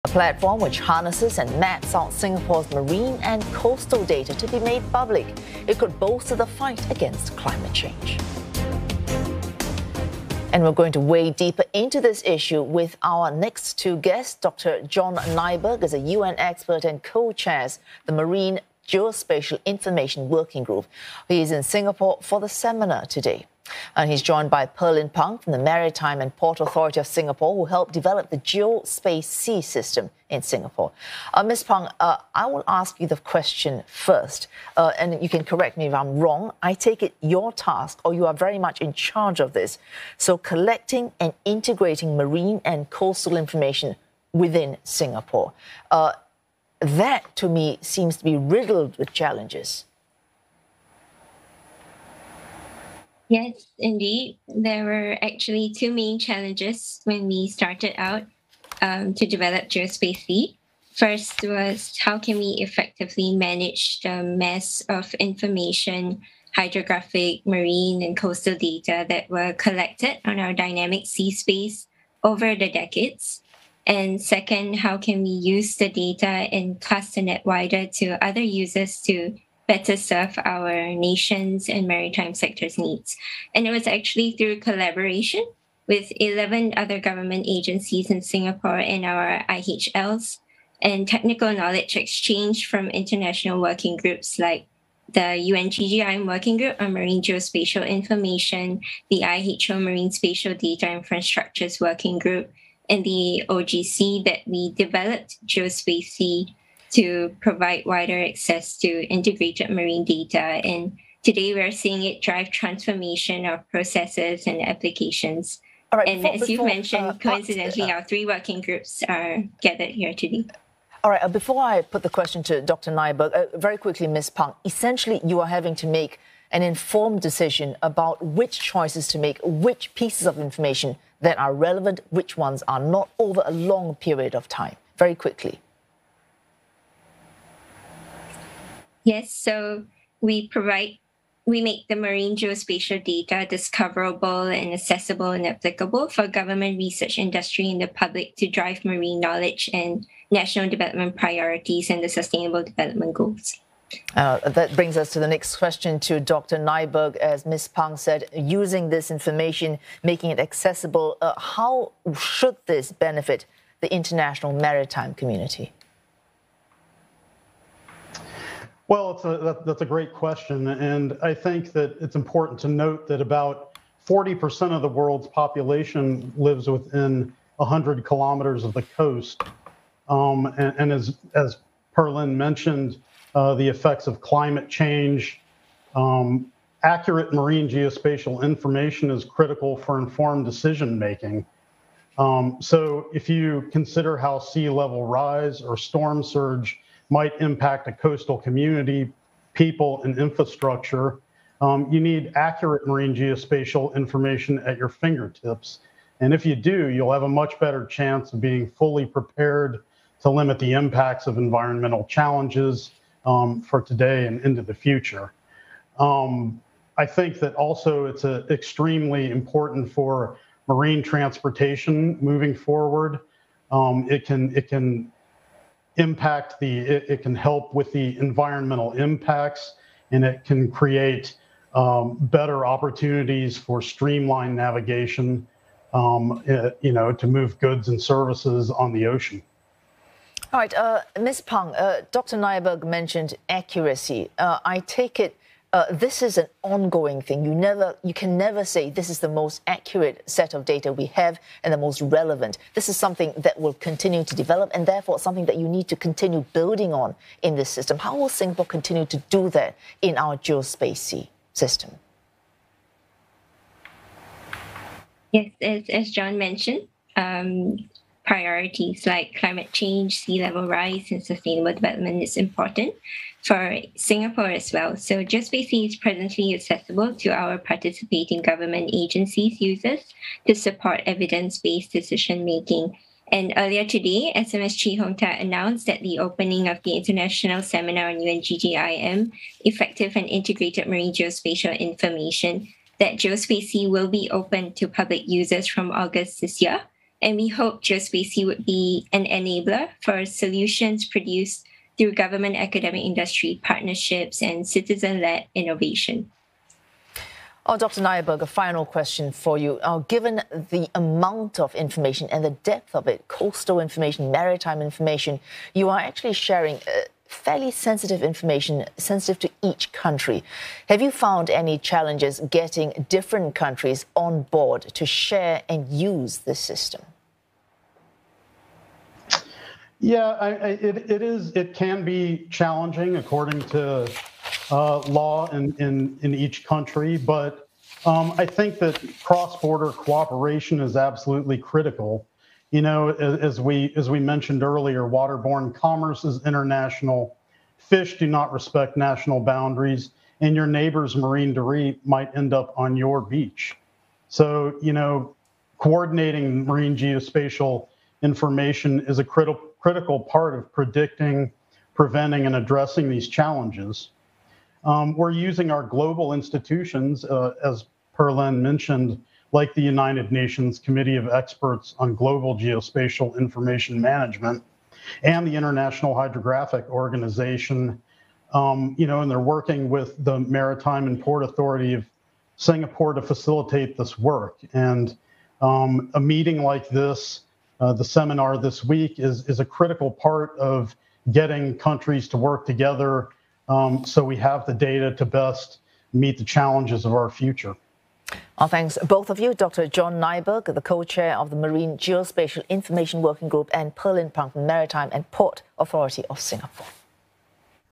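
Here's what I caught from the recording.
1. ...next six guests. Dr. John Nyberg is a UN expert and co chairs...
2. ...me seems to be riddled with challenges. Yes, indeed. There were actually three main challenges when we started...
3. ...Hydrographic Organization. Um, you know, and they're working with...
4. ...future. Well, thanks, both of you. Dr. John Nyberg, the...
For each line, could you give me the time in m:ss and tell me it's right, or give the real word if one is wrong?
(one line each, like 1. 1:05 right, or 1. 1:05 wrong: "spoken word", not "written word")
1. 0:13 wrong: "two", not "six"
2. 0:47 wrong: "two", not "three"
3. 6:16 right
4. 6:37 right.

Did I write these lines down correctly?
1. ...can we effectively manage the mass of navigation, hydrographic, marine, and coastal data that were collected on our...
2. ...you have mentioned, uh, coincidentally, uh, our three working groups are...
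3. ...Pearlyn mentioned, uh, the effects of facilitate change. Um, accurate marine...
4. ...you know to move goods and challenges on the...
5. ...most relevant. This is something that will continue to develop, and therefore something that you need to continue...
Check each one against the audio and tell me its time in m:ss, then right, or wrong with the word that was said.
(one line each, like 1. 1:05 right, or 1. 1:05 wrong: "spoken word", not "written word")
1. 1:02 wrong: "information", not "navigation"
2. 1:56 right
3. 3:01 wrong: "climate", not "facilitate"
4. 3:56 wrong: "services", not "challenges"
5. 4:11 right.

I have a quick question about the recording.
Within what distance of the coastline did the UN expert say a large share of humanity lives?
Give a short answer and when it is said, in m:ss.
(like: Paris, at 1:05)
100 kilometers, at 2:57.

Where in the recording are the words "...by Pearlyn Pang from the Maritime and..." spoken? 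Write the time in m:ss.
0:24.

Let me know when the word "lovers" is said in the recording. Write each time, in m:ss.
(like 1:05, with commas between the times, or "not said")
not said.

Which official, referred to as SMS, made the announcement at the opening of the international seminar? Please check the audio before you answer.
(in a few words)
Chee Hong Tat.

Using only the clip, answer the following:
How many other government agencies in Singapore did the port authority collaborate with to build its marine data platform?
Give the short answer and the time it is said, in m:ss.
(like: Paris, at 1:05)
11, at 1:26.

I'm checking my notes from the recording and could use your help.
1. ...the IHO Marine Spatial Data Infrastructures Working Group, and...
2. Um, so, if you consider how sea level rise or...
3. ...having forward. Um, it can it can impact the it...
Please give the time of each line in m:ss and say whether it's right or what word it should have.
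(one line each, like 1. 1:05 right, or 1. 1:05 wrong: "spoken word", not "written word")
1. 1:39 right
2. 3:12 right
3. 3:42 wrong: "moving", not "having".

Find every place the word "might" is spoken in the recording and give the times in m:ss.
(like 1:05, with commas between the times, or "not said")
3:17, 5:52.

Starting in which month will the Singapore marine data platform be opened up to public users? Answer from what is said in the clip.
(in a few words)
August.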